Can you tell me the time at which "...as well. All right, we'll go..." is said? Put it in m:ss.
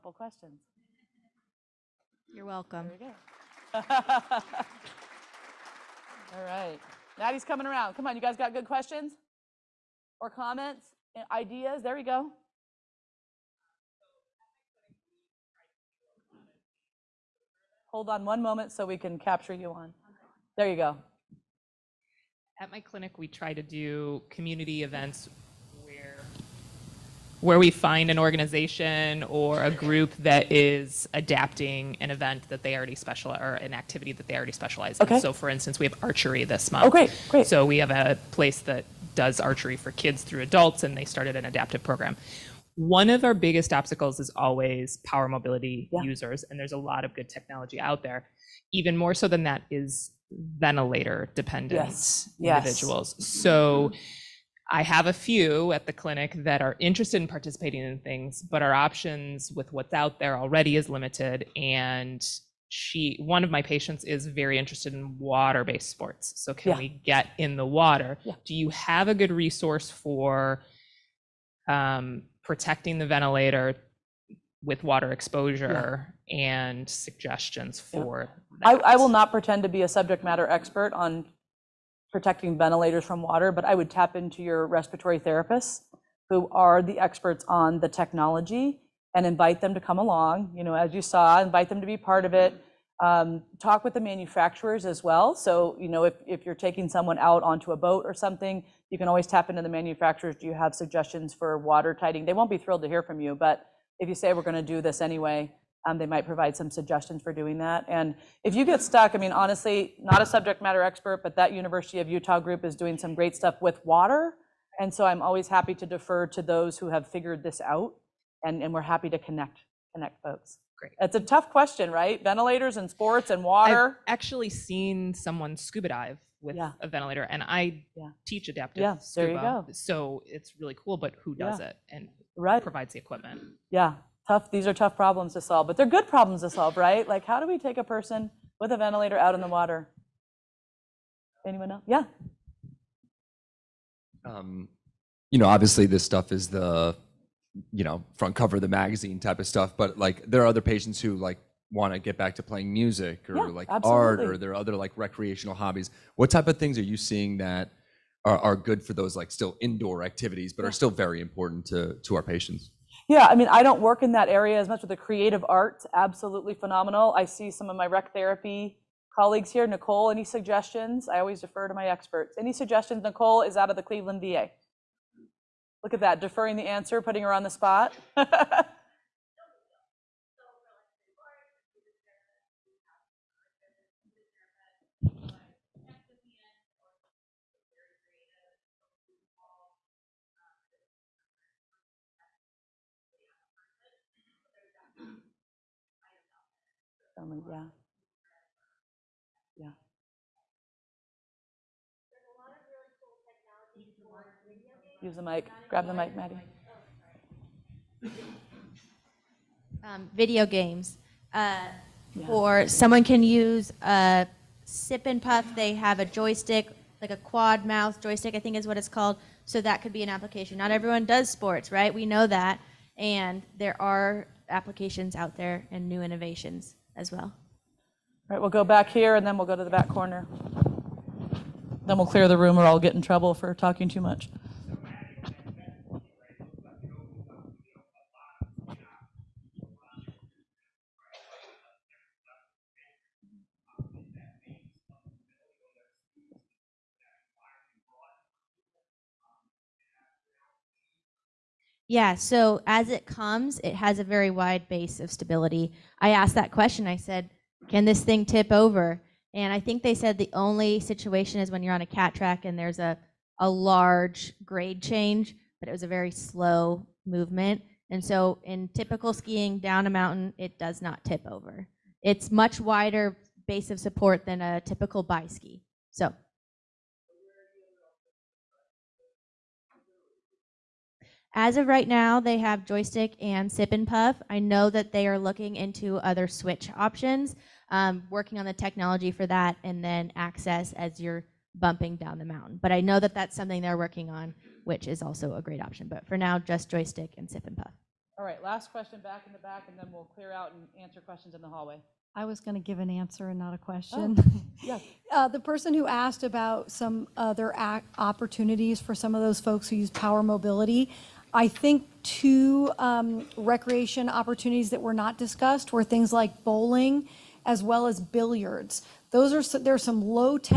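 3:46.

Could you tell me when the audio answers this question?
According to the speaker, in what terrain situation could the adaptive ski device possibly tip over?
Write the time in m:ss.
4:21.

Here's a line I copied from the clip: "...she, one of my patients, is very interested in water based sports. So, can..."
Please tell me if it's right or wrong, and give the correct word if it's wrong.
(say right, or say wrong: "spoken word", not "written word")
right.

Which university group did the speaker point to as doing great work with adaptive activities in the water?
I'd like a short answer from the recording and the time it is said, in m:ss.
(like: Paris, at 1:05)
University of Utah, at 1:51.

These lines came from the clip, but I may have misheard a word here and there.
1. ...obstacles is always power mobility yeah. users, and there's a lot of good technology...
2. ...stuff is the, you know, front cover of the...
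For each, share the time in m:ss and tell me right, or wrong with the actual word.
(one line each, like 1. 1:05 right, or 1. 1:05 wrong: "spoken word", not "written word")
1. 0:43 right
2. 2:26 right.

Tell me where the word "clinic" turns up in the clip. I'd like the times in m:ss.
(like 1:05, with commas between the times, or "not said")
0:22, 0:55.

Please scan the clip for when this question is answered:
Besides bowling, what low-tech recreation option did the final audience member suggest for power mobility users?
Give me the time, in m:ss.
5:17.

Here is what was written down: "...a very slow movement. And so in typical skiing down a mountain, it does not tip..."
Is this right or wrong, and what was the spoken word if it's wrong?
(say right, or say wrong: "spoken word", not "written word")
right.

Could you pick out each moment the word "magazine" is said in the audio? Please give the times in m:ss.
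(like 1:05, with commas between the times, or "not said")
2:28.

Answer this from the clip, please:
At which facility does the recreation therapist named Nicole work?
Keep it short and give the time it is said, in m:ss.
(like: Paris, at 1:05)
Cleveland VA, at 2:53.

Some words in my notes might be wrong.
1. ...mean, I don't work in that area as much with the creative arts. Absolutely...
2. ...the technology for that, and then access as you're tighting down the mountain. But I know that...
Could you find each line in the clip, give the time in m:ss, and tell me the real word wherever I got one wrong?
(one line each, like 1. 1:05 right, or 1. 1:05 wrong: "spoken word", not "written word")
1. 2:43 right
2. 4:48 wrong: "bumping", not "tighting".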